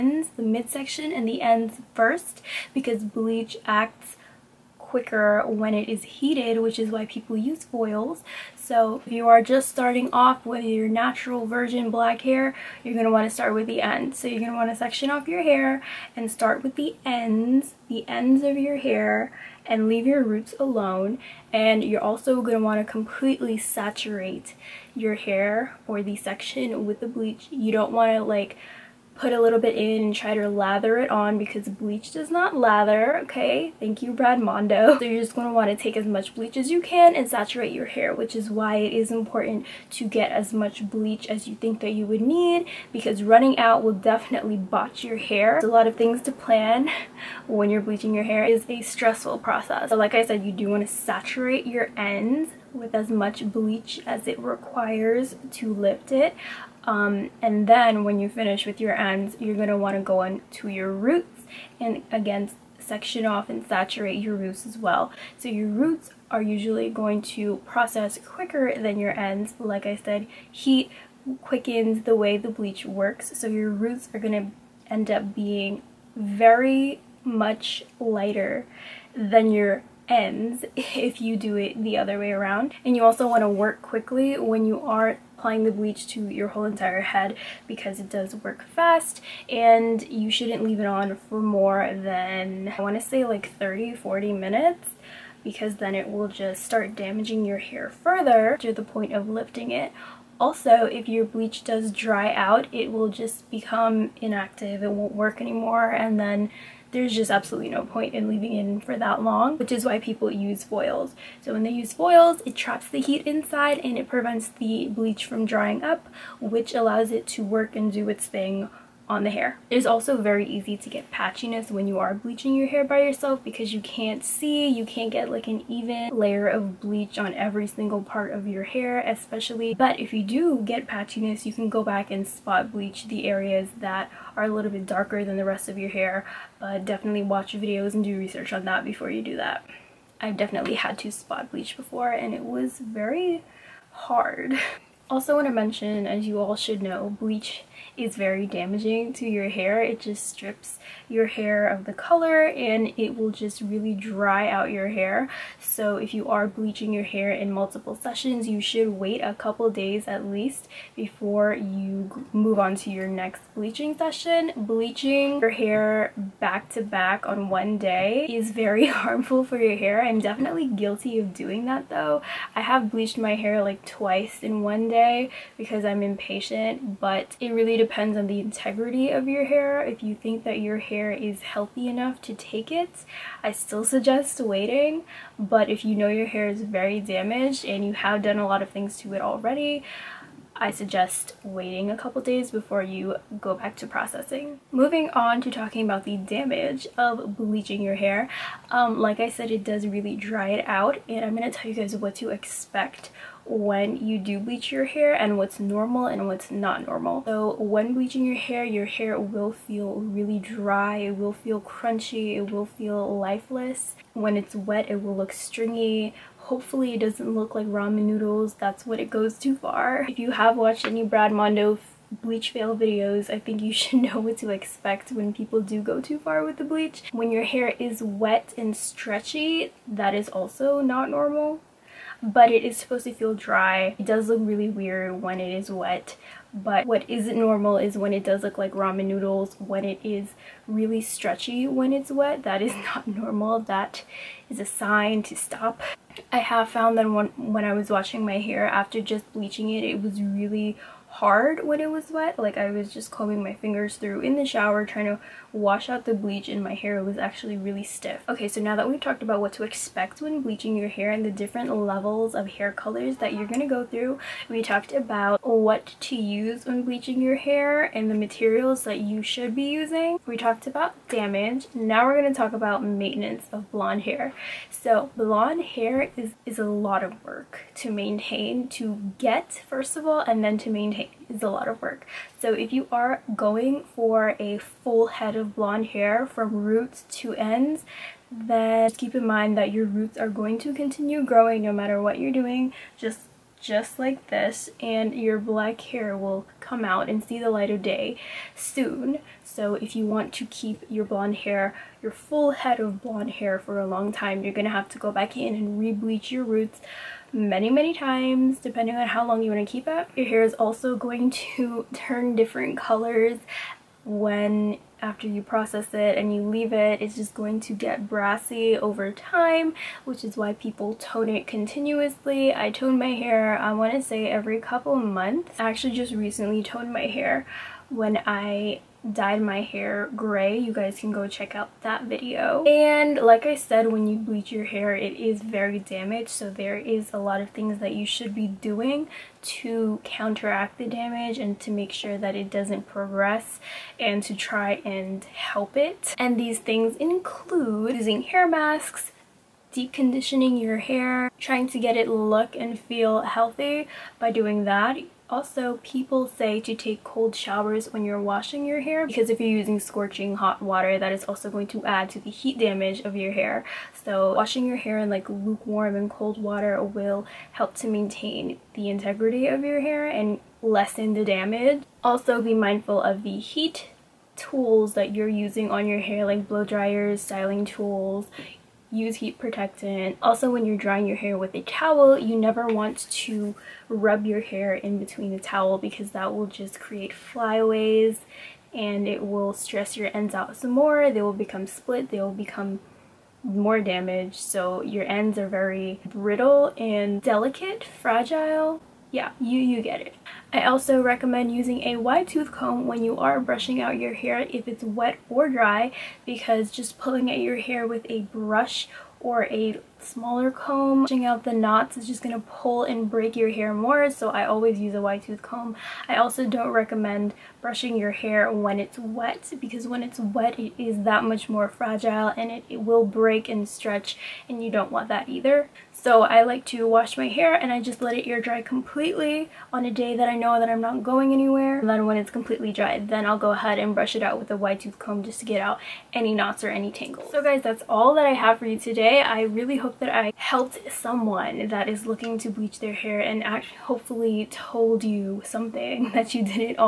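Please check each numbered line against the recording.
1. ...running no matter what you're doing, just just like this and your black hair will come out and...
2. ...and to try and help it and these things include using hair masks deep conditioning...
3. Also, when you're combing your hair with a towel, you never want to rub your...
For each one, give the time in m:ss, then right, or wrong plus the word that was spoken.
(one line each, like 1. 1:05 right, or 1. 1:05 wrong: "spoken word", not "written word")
1. 4:51 wrong: "growing", not "running"
2. 5:43 right
3. 6:20 wrong: "drying", not "combing".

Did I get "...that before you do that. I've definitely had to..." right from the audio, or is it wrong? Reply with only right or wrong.
right.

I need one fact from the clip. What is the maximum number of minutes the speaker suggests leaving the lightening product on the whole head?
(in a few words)
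30-40 minutes.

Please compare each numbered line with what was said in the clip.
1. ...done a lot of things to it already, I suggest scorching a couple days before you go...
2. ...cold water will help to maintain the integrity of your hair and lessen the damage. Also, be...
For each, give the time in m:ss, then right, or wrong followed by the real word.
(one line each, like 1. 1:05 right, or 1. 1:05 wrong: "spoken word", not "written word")
1. 3:08 wrong: "waiting", not "scorching"
2. 6:06 right.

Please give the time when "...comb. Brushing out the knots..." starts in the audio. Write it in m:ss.
6:50.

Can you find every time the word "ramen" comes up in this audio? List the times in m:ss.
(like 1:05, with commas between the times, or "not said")
3:37, 3:58.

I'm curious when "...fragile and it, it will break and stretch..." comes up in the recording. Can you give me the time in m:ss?
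7:01.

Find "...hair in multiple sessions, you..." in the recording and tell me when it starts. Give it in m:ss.
2:37.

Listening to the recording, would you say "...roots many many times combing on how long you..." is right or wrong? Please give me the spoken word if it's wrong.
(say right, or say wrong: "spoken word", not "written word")
wrong: "depending", not "combing".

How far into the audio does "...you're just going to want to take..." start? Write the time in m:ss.
0:35.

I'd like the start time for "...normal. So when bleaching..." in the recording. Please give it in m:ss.
3:26.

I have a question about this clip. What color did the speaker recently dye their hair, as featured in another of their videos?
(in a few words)
gray.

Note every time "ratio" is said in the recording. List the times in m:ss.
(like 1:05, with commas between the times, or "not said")
not said.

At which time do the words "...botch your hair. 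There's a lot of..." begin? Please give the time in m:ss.
0:44.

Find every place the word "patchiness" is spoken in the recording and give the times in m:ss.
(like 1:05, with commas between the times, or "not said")
2:01, 2:10.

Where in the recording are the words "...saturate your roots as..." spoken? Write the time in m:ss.
1:03.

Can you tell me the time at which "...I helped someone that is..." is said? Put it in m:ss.
7:20.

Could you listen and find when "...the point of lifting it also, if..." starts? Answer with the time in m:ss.
1:38.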